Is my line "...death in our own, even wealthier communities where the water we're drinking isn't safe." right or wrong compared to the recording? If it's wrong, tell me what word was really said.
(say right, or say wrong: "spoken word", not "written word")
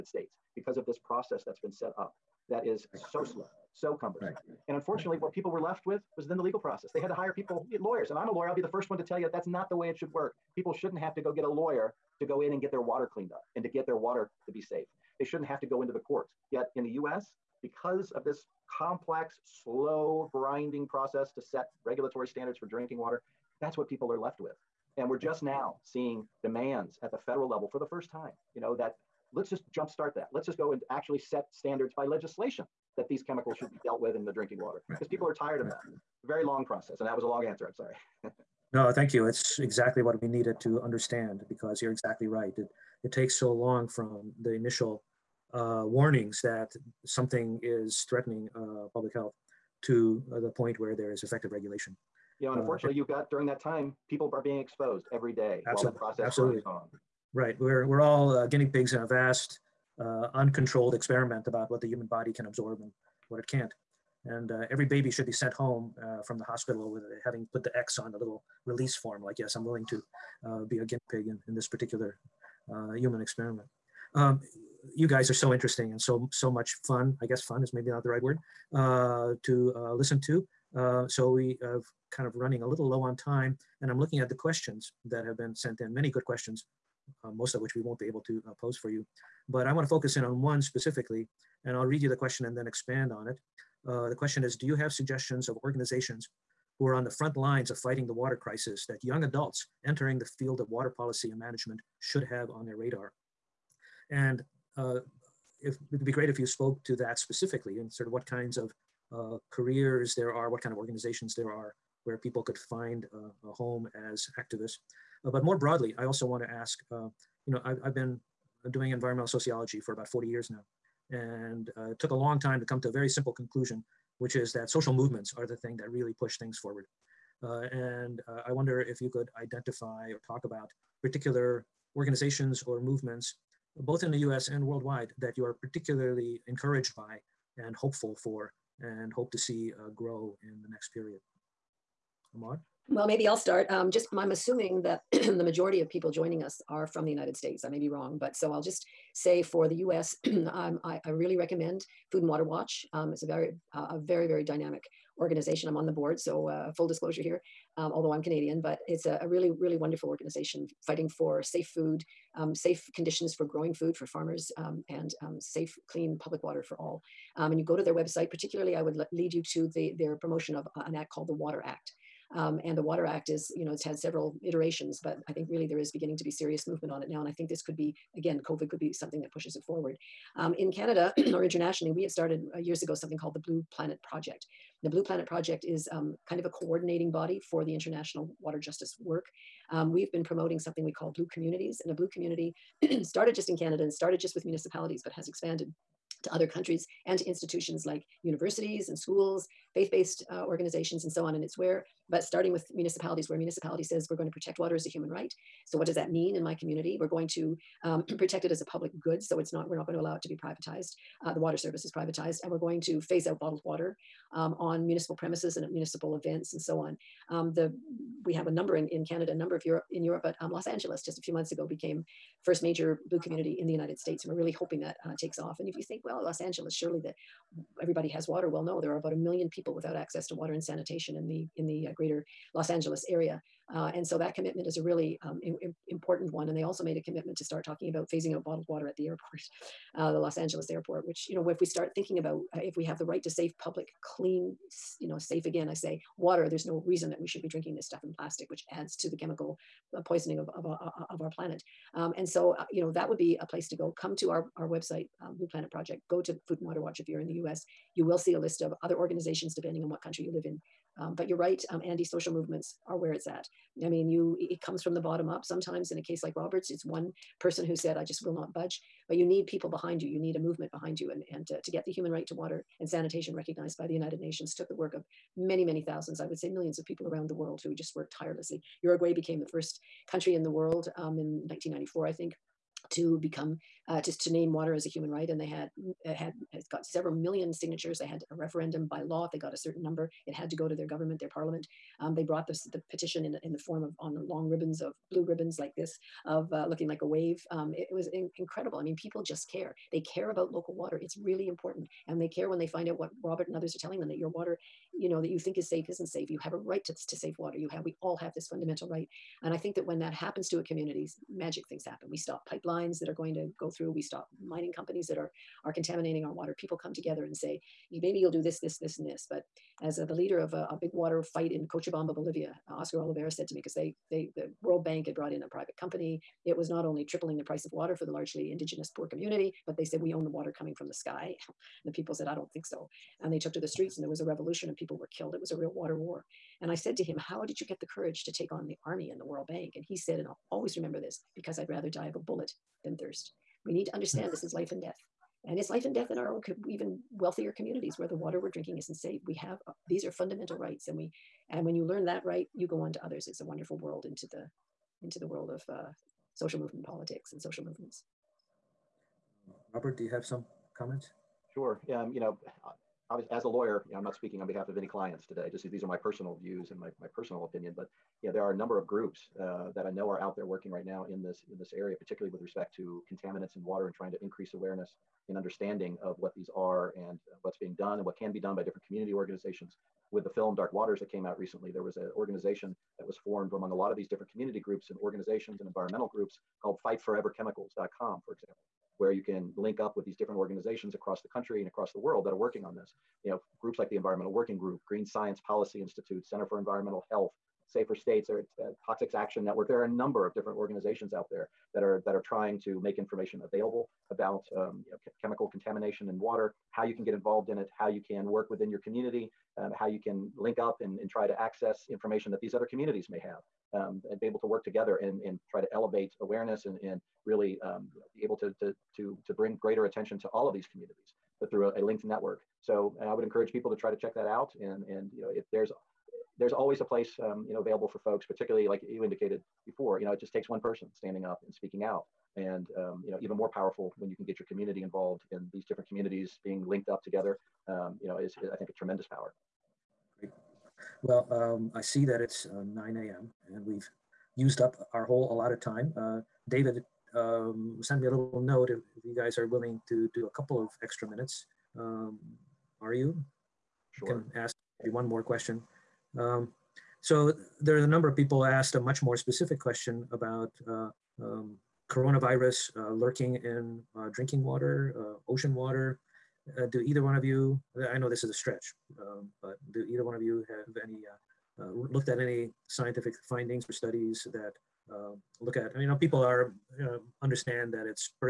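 right.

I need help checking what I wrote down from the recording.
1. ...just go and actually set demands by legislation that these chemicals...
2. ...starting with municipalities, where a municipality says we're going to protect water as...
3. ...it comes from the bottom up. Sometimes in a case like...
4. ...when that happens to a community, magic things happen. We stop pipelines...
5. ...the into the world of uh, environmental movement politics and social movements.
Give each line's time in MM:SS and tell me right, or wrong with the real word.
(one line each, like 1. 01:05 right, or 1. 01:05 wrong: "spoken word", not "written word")
1. 00:30 wrong: "standards", not "demands"
2. 03:22 right
3. 04:24 right
4. 05:09 right
5. 05:54 wrong: "social", not "environmental".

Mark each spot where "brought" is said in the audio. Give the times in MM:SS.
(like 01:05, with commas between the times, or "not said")
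04:52, 05:25.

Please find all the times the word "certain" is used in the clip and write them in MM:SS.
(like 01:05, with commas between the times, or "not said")
04:49.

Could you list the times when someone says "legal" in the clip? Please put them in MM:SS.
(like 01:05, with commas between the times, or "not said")
00:06.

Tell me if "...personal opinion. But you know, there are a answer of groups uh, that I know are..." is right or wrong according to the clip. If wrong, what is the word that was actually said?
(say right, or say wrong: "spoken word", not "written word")
wrong: "number", not "answer".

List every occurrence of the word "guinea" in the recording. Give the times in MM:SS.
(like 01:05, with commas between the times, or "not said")
00:58, 01:10.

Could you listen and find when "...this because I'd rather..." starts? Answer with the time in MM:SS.
05:40.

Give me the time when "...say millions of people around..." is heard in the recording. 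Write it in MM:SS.
04:36.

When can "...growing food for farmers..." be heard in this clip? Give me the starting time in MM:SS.
02:43.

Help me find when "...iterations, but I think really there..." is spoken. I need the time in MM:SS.
02:54.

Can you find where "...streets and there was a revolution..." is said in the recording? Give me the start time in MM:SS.
05:33.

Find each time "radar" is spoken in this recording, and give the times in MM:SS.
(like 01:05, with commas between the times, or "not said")
01:42.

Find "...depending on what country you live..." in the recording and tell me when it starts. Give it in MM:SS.
04:19.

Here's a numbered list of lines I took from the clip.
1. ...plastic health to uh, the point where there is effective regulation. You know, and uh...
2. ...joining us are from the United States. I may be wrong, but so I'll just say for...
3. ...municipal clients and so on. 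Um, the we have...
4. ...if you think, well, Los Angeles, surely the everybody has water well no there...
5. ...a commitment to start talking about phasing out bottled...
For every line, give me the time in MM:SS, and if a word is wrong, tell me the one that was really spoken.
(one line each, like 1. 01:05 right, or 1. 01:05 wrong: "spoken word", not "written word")
1. 00:48 wrong: "public", not "plastic"
2. 02:26 right
3. 03:35 wrong: "events", not "clients"
4. 03:45 right
5. 03:56 right.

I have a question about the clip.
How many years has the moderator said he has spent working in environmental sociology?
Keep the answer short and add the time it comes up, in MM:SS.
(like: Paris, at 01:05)
40 years, at 01:59.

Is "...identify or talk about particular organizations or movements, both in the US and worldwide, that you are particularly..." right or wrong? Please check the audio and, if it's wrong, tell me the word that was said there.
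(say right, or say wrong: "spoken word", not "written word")
right.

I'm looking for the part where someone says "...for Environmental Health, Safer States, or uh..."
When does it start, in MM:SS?
06:36.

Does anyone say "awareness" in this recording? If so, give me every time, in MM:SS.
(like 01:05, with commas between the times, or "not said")
06:14, 06:56.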